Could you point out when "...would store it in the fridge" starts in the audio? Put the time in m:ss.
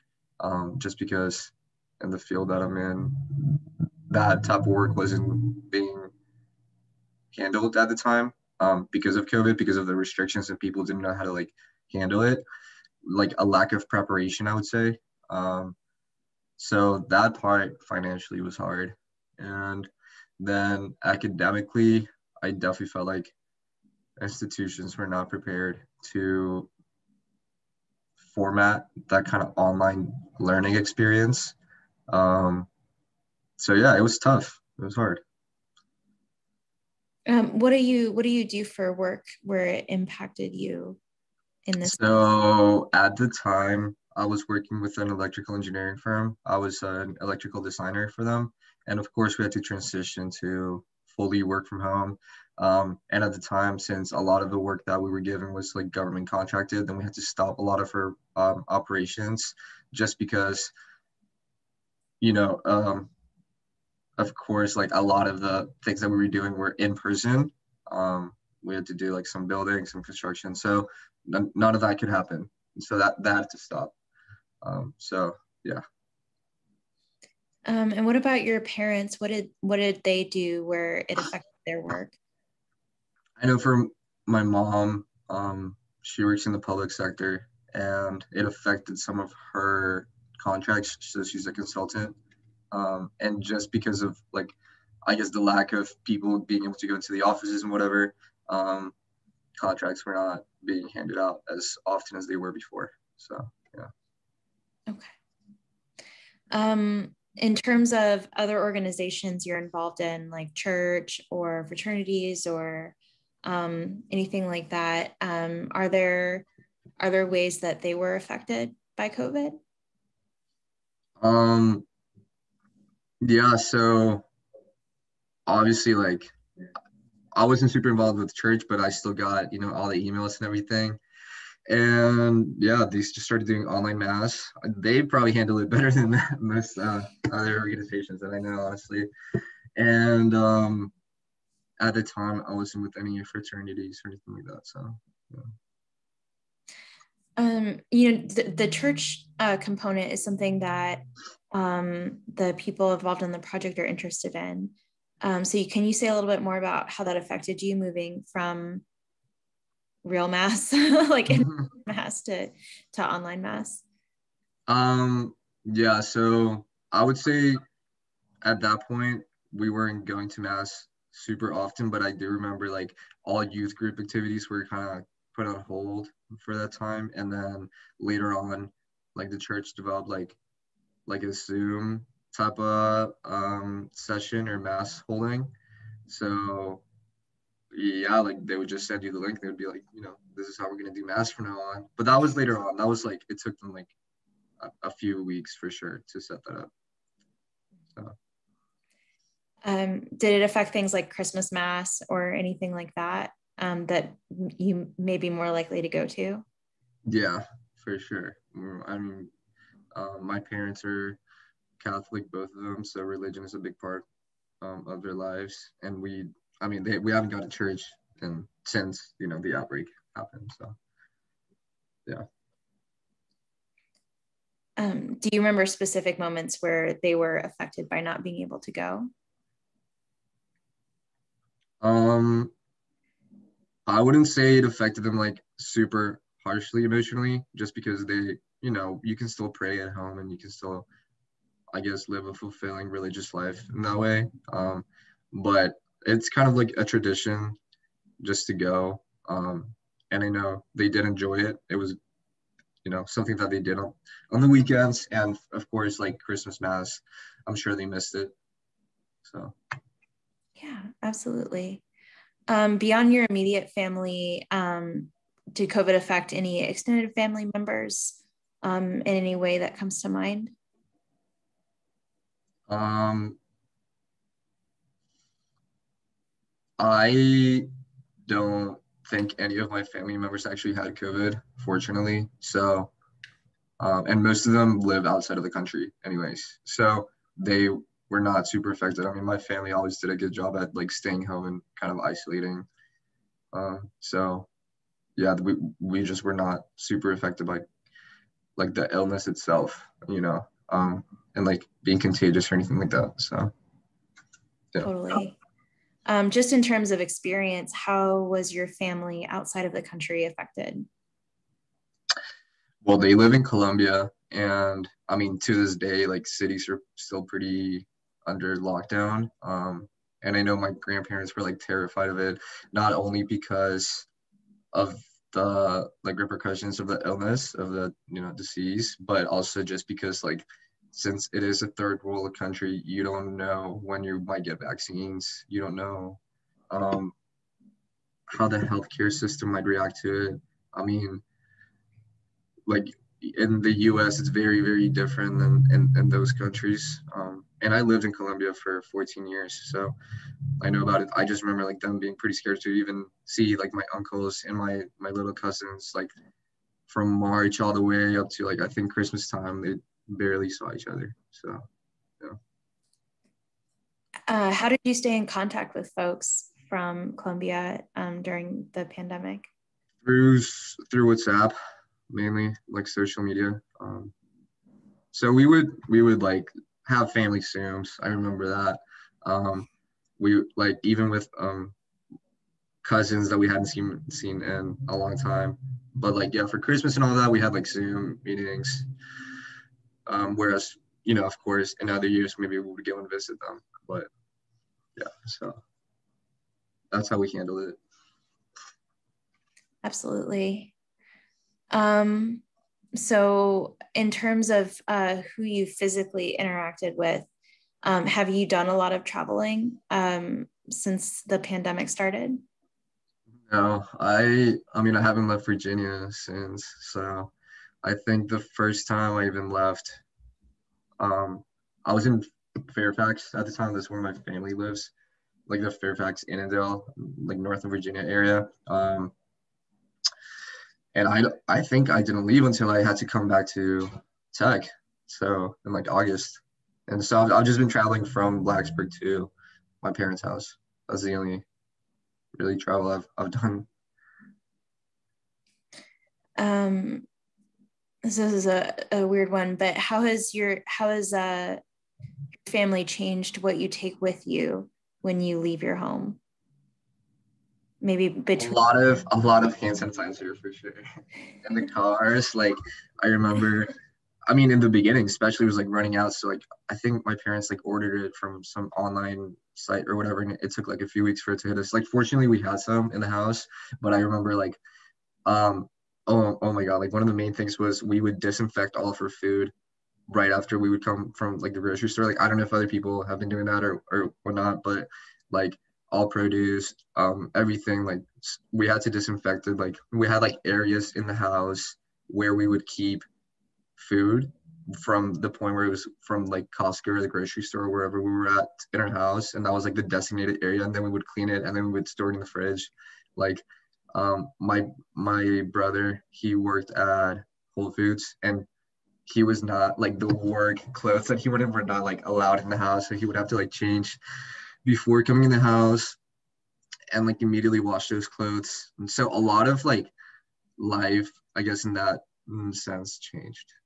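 8:21.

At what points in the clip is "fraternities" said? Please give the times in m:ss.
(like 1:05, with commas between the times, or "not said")
1:51, 2:23.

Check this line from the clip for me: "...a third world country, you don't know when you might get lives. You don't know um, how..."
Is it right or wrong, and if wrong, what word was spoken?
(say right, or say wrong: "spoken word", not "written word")
wrong: "vaccines", not "lives".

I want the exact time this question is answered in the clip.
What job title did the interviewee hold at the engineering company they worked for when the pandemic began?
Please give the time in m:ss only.
0:47.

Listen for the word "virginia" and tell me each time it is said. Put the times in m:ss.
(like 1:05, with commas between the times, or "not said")
6:55, 7:07.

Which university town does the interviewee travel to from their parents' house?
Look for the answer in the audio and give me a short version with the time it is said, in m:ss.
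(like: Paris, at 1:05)
Blacksburg, at 7:18.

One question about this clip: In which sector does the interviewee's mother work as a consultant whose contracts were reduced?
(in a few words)
Public sector.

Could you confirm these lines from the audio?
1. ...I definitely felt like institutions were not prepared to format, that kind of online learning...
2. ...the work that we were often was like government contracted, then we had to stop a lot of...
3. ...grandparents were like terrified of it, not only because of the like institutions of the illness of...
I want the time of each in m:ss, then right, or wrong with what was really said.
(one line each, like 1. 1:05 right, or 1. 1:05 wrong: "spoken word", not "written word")
1. 0:22 right
2. 0:54 wrong: "given", not "often"
3. 5:20 wrong: "repercussions", not "institutions".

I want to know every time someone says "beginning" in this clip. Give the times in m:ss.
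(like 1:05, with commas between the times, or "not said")
7:44.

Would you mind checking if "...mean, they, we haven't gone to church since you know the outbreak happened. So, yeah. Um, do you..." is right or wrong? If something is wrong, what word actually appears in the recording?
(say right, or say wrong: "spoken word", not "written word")
right.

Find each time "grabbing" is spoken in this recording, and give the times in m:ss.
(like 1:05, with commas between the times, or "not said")
not said.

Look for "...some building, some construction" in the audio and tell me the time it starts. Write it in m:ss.
1:09.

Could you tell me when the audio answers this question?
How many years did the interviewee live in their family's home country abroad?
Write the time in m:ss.
5:48.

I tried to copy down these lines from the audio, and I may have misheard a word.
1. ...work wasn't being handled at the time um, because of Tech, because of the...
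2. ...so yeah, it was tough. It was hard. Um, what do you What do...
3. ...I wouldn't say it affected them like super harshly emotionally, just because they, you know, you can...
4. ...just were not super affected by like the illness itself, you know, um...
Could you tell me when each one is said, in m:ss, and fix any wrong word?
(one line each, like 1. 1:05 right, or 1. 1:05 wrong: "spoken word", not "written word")
1. 0:04 wrong: "COVID", not "Tech"
2. 0:33 right
3. 3:53 right
4. 4:56 right.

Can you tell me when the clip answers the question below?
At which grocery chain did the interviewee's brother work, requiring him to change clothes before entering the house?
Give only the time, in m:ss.
8:27.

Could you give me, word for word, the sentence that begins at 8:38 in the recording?
And so a lot of like life, I guess, in that sense changed.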